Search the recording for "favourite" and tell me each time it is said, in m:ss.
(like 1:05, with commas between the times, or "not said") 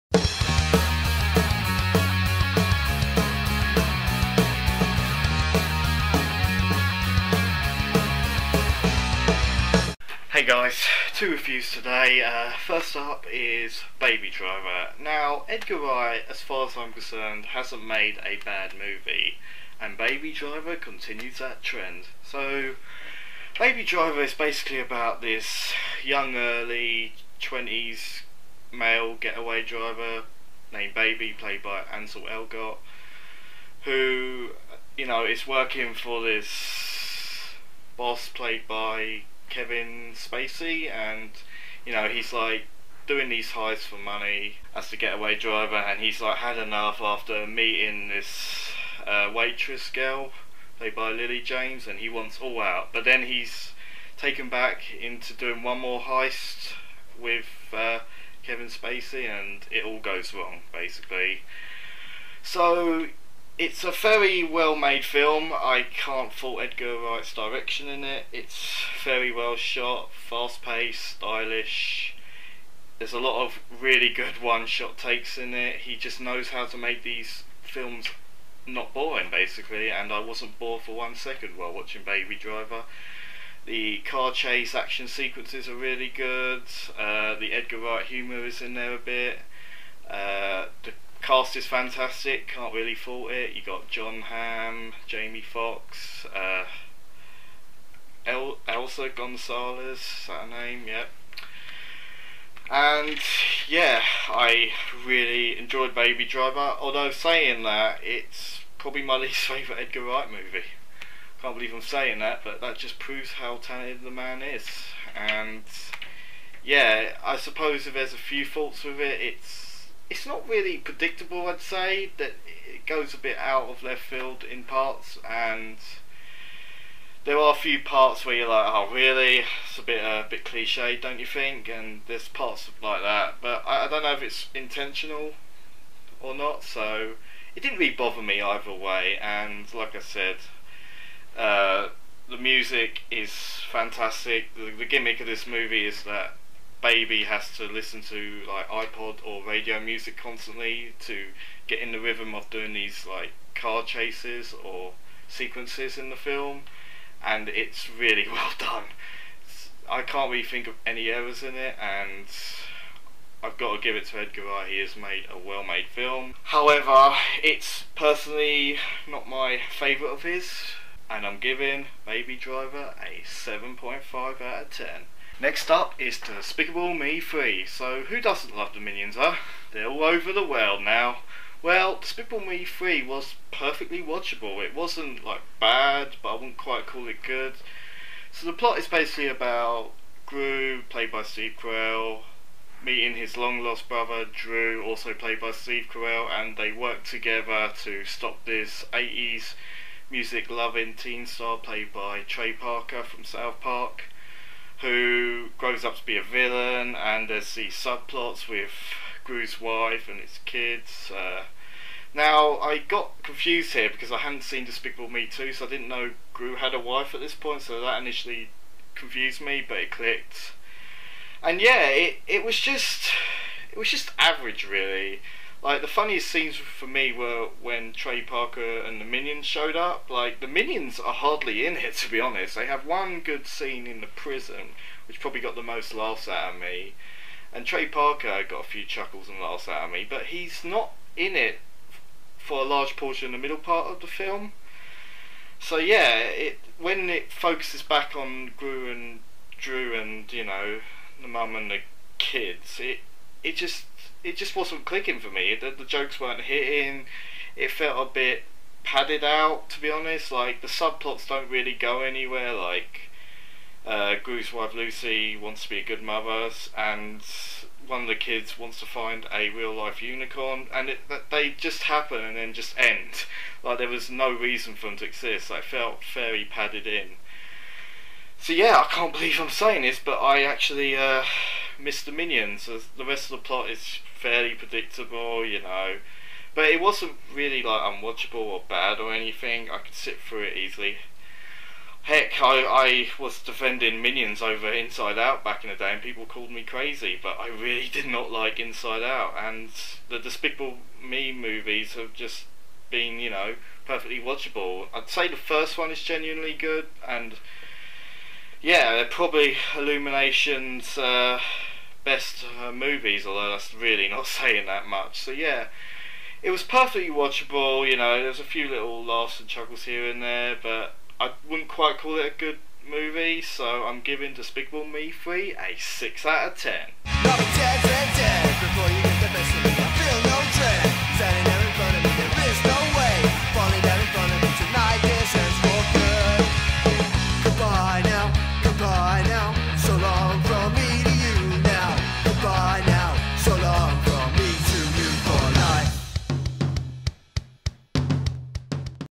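1:49, 2:49.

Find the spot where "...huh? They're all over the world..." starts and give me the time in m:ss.
2:59.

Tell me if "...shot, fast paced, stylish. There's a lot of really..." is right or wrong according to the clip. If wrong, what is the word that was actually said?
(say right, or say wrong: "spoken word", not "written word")
right.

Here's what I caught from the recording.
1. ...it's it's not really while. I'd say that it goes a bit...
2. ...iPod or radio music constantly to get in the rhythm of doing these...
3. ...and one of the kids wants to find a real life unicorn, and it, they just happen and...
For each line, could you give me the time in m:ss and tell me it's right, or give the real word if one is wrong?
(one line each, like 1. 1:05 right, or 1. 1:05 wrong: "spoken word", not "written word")
1. 1:59 wrong: "predictable", not "while"
2. 2:28 right
3. 4:26 right.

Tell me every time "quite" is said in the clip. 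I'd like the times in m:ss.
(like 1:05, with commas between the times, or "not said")
3:06, 5:21.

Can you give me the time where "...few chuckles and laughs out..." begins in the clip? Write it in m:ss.
3:58.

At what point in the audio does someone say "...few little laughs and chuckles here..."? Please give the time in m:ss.
5:18.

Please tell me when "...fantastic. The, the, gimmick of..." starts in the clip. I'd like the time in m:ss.
2:23.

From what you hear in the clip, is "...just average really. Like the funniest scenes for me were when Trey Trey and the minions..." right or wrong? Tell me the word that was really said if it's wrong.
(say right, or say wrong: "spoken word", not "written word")
wrong: "Parker", not "Trey".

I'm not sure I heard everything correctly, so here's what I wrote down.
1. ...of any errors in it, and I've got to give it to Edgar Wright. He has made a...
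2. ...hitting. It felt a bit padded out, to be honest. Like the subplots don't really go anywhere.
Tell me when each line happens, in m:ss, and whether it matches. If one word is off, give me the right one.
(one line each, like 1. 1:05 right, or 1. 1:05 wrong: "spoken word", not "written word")
1. 2:40 right
2. 4:16 right.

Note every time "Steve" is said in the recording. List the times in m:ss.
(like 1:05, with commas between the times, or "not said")
3:11, 3:15.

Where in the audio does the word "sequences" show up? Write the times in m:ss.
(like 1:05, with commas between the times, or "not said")
1:25, 2:35.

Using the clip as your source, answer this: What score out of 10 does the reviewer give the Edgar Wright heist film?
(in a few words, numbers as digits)
7.5.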